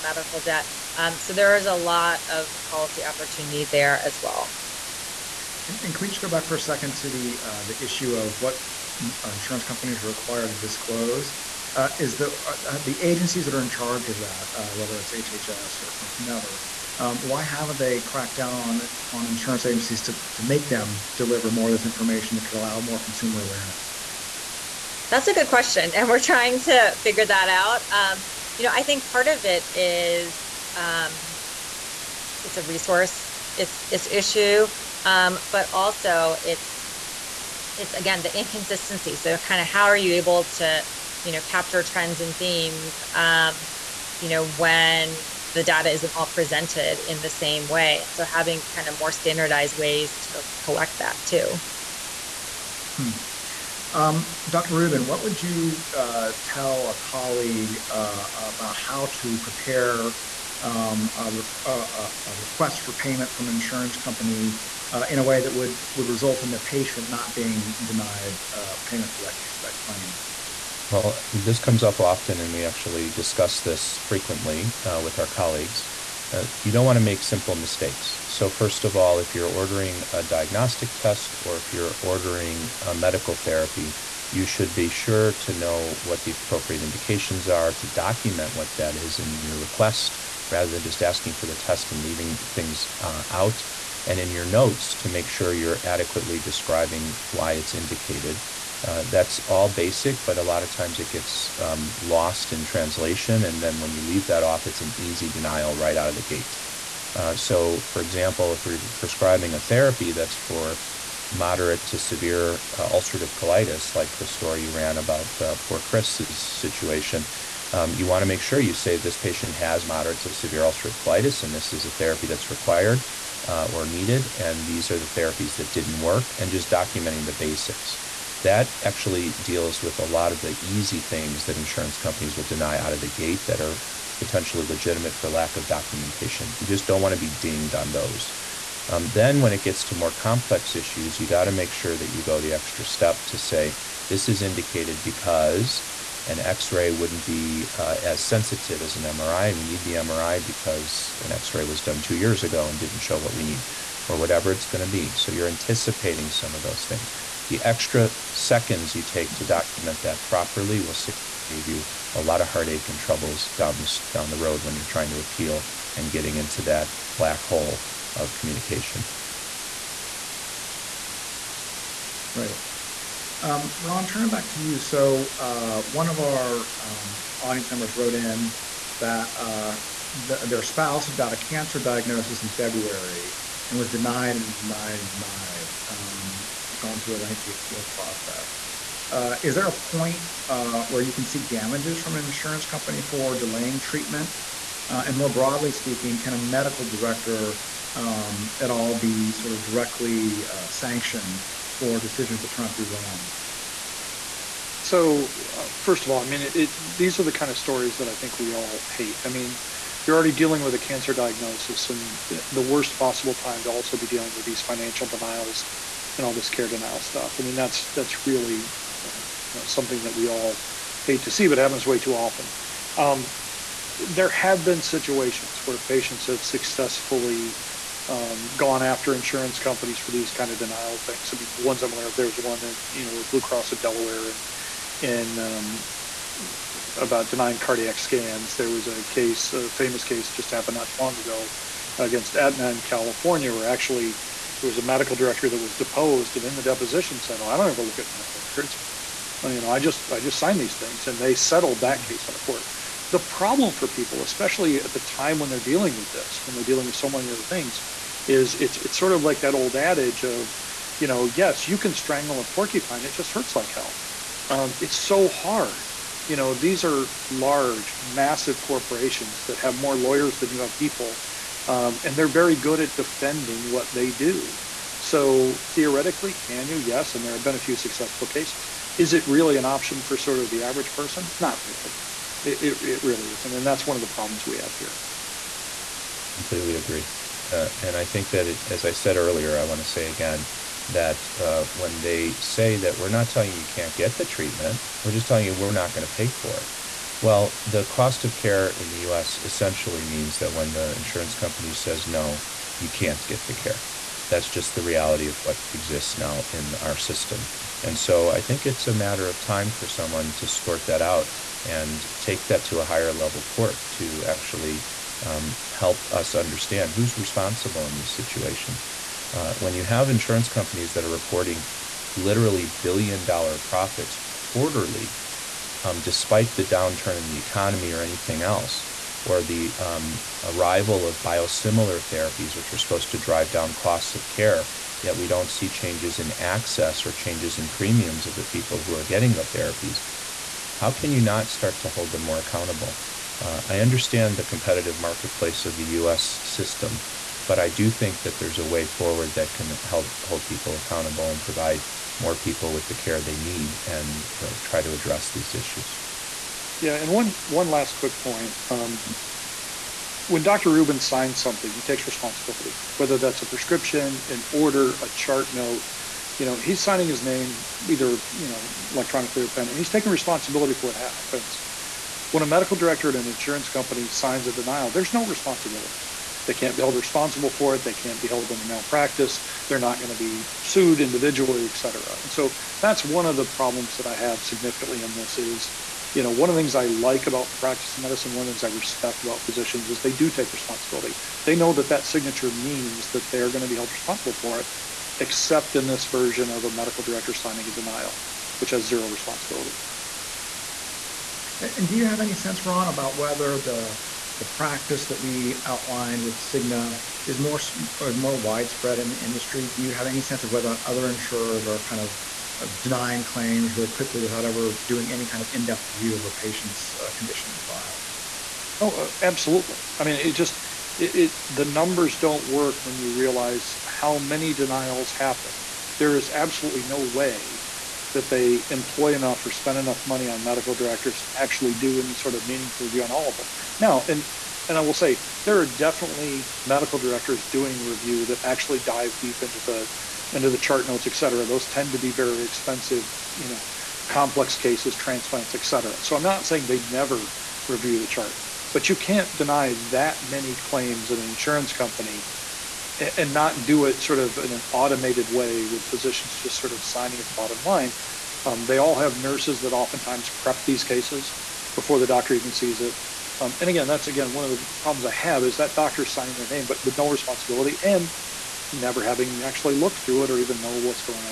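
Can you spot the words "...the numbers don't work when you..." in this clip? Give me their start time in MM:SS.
07:01.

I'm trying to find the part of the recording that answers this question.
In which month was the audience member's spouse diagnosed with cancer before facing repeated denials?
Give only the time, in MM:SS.
03:02.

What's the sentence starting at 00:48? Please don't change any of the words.
And so having kind of more standardized ways to collect that too.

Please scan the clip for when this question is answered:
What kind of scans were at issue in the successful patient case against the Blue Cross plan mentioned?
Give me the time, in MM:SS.
03:57.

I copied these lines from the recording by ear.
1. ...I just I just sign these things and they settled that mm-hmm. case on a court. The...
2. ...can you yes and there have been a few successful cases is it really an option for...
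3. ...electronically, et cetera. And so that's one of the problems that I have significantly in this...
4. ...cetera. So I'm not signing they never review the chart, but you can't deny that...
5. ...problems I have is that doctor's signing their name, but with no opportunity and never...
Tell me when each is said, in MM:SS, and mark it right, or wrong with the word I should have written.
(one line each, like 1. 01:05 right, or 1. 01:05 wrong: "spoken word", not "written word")
1. 04:09 right
2. 04:36 right
3. 06:21 wrong: "individually", not "electronically"
4. 07:25 wrong: "saying", not "signing"
5. 07:44 wrong: "responsibility", not "opportunity".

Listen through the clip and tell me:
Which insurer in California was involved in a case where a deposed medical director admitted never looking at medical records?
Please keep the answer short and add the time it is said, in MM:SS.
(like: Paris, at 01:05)
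Aetna, at 04:02.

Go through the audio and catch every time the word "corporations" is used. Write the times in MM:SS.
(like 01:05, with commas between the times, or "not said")
04:28.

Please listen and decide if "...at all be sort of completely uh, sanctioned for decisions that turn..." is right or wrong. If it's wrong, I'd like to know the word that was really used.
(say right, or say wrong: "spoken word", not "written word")
wrong: "directly", not "completely".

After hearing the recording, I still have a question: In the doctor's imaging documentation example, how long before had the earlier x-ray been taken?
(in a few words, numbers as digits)
two years ago.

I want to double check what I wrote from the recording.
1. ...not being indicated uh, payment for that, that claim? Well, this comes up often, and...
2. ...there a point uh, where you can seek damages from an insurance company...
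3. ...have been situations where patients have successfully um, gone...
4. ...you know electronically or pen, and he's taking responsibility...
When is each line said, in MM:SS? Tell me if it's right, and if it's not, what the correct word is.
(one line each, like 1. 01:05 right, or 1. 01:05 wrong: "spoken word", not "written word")
1. 01:07 wrong: "denied", not "indicated"
2. 03:09 right
3. 03:44 right
4. 06:08 right.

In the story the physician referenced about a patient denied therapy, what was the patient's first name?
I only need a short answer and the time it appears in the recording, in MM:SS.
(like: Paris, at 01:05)
Chris, at 01:55.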